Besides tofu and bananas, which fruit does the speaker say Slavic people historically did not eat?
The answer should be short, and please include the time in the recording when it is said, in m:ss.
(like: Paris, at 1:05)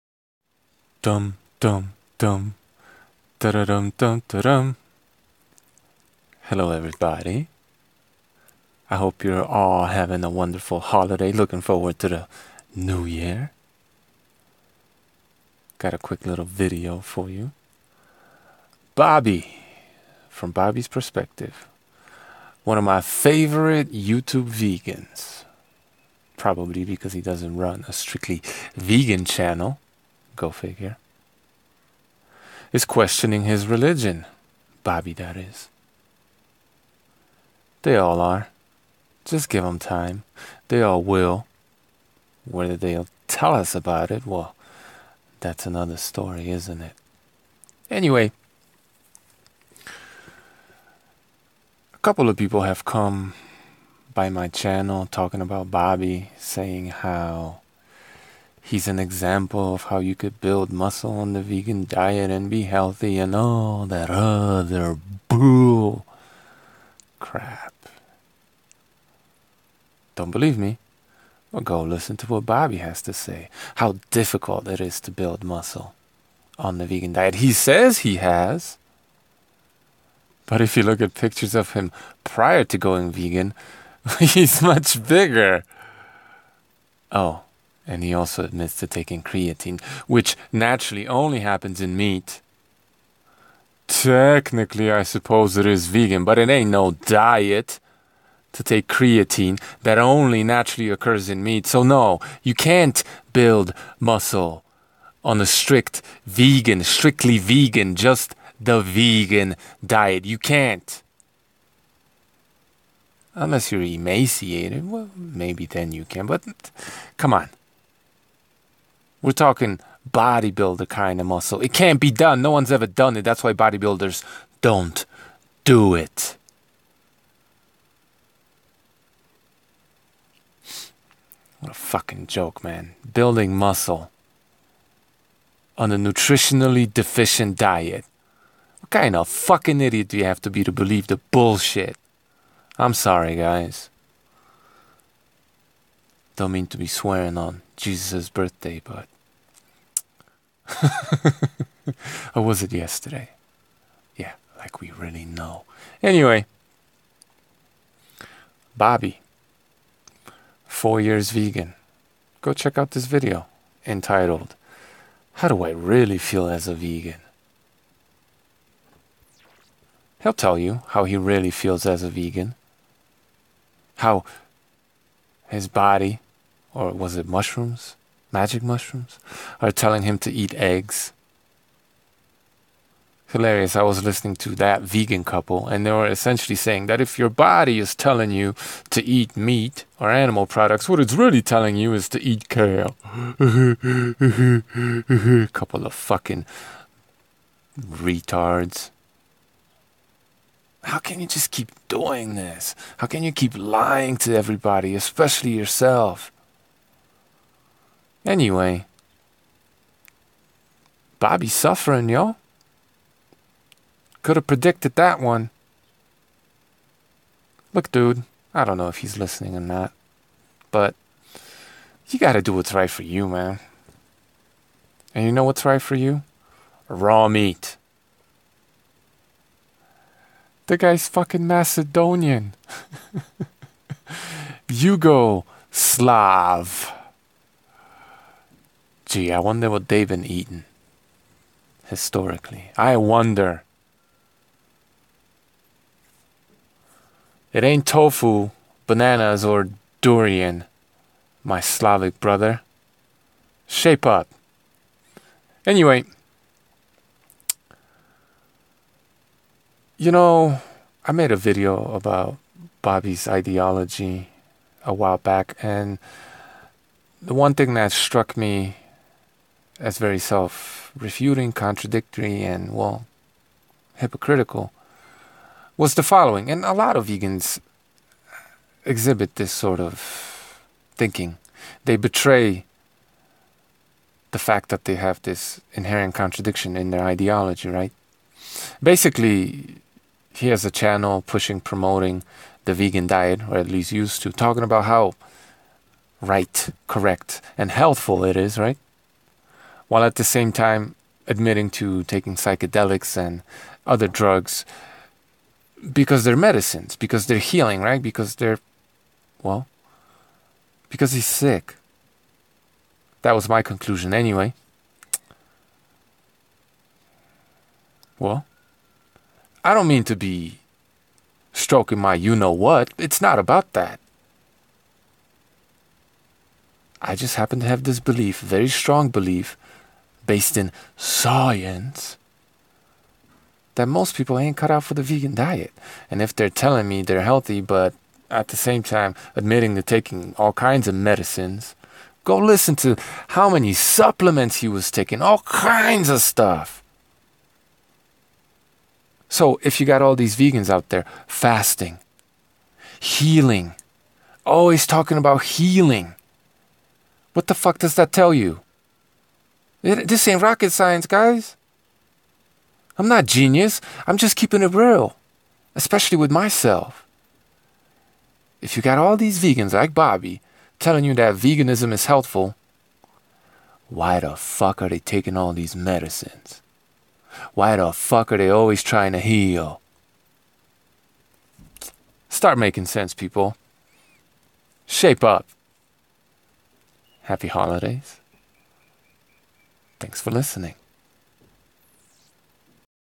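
Durian, at 4:09.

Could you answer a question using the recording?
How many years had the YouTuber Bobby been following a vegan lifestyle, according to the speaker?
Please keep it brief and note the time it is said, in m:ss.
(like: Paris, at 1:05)
4, at 2:40.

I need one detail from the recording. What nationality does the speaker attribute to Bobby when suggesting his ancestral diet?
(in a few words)
Macedonian.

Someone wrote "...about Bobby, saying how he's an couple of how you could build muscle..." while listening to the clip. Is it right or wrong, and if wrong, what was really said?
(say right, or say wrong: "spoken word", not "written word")
wrong: "example", not "couple".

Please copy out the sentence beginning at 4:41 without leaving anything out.
They betray the fact that they have this inherent contradiction in their ideology, right?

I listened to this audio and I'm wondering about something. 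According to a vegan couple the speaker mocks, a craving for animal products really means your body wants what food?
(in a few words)
Kale.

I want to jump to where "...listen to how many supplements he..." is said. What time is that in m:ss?
5:42.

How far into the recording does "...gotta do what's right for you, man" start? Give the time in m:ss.
3:42.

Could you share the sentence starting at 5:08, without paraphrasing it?
Because they're, well, because he's sick.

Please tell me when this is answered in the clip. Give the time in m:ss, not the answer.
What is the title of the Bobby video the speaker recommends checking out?
2:45.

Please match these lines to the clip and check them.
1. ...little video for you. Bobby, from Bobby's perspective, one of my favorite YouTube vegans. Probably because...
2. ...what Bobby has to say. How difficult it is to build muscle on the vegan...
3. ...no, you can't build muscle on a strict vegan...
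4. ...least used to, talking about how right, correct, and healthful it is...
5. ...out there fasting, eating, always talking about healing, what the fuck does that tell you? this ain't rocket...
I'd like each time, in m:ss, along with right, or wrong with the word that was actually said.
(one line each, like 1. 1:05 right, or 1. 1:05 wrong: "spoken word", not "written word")
1. 0:16 right
2. 1:12 right
3. 1:41 right
4. 4:53 right
5. 5:50 wrong: "healing", not "eating".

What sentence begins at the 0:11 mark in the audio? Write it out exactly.
Looking forward to the new year.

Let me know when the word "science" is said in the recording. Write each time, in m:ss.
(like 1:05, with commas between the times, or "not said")
5:30, 6:00.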